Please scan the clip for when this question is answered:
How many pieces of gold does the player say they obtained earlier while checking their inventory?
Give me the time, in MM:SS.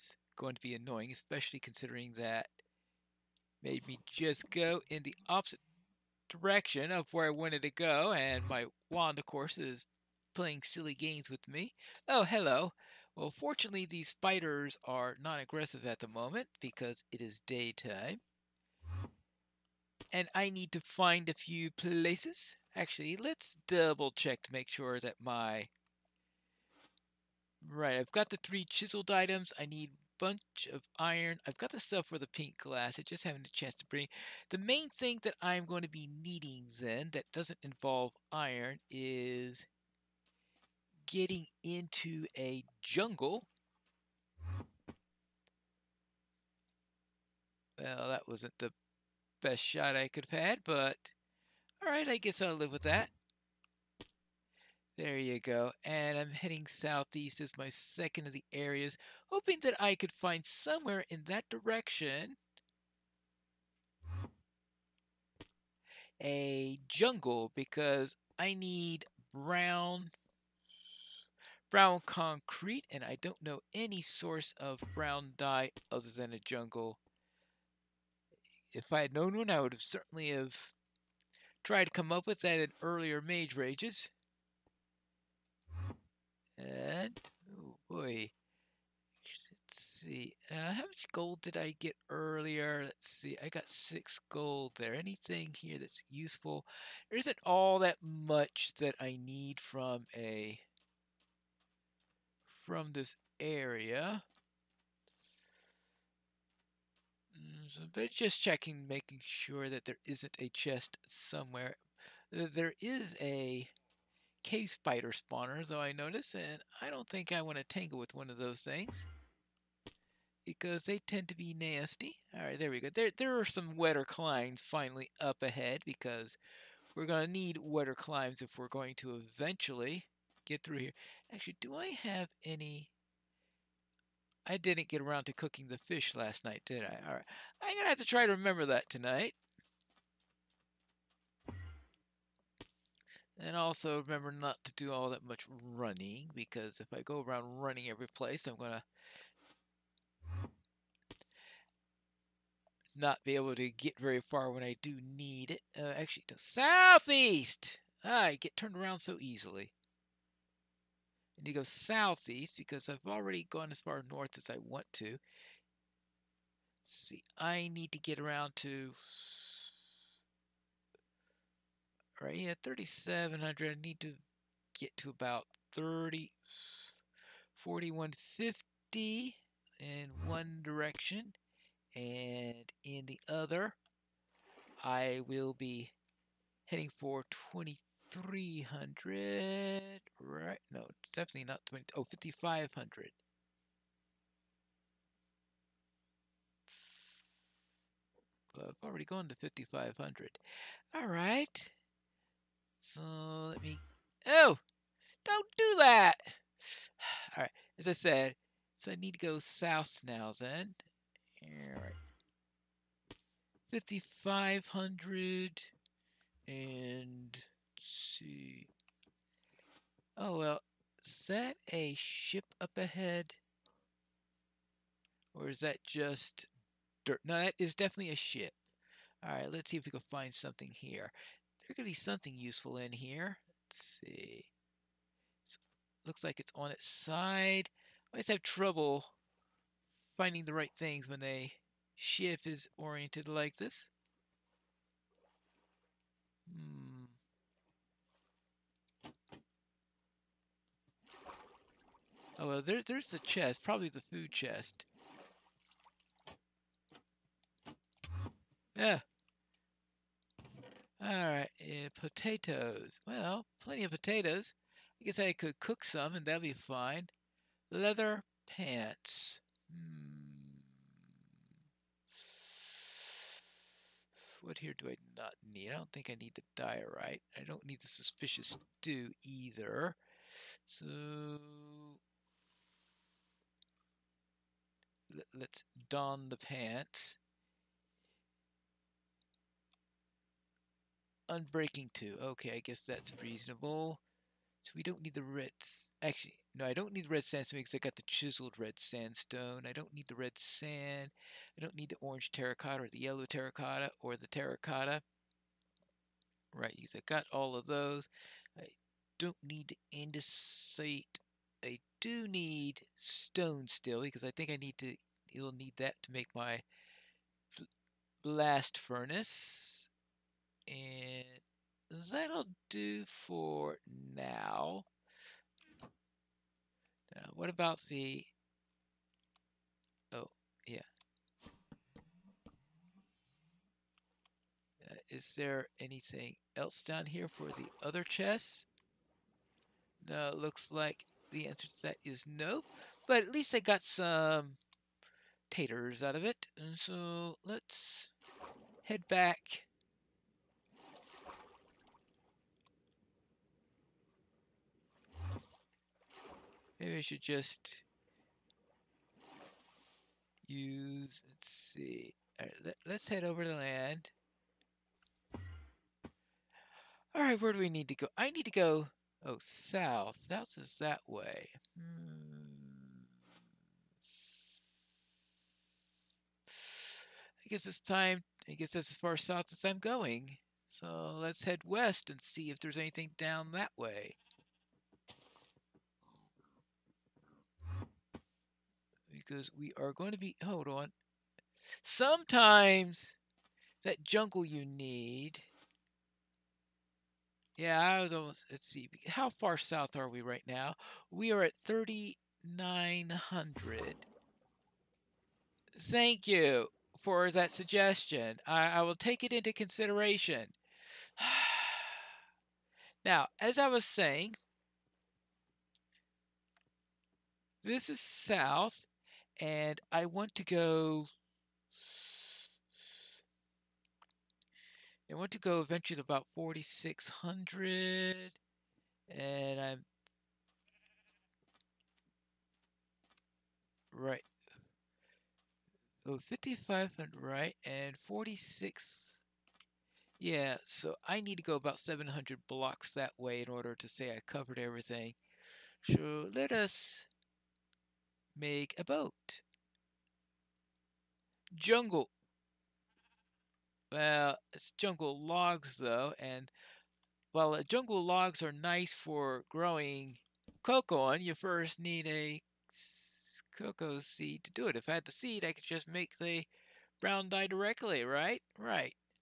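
01:33.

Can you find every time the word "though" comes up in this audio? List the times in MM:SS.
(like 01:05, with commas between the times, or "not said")
01:55, 07:35.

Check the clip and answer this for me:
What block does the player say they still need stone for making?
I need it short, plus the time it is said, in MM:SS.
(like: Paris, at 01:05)
blast furnace, at 05:18.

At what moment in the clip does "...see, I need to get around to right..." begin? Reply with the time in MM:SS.
02:46.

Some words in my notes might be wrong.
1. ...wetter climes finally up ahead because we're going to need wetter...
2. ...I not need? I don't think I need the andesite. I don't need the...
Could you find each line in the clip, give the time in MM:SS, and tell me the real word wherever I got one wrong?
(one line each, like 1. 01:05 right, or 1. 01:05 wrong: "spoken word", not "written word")
1. 02:03 right
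2. 04:34 wrong: "diorite", not "andesite".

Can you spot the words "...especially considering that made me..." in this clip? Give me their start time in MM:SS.
00:01.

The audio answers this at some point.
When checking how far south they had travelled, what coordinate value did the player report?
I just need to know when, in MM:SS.
06:41.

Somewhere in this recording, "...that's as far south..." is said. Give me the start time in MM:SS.
06:18.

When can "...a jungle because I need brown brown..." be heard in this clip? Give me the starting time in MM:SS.
01:06.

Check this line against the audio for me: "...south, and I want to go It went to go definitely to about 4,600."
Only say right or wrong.
wrong.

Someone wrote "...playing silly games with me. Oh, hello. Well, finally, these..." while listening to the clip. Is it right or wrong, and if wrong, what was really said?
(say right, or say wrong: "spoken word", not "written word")
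wrong: "fortunately", not "finally".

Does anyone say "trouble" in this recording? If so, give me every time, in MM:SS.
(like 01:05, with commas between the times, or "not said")
03:58.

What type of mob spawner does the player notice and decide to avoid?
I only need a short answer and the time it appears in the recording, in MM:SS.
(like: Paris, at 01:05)
cave spider spawner, at 01:54.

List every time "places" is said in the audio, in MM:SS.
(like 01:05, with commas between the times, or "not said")
00:21, 02:28.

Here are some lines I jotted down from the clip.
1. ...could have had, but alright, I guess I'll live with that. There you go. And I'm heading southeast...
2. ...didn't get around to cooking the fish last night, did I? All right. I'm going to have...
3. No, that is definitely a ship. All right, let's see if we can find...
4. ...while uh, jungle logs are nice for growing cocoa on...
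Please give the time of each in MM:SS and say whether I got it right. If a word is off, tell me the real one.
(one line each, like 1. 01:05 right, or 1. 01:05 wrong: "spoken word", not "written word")
1. 00:50 right
2. 02:14 right
3. 03:47 right
4. 07:37 right.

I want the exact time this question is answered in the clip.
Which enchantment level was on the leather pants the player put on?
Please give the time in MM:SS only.
04:51.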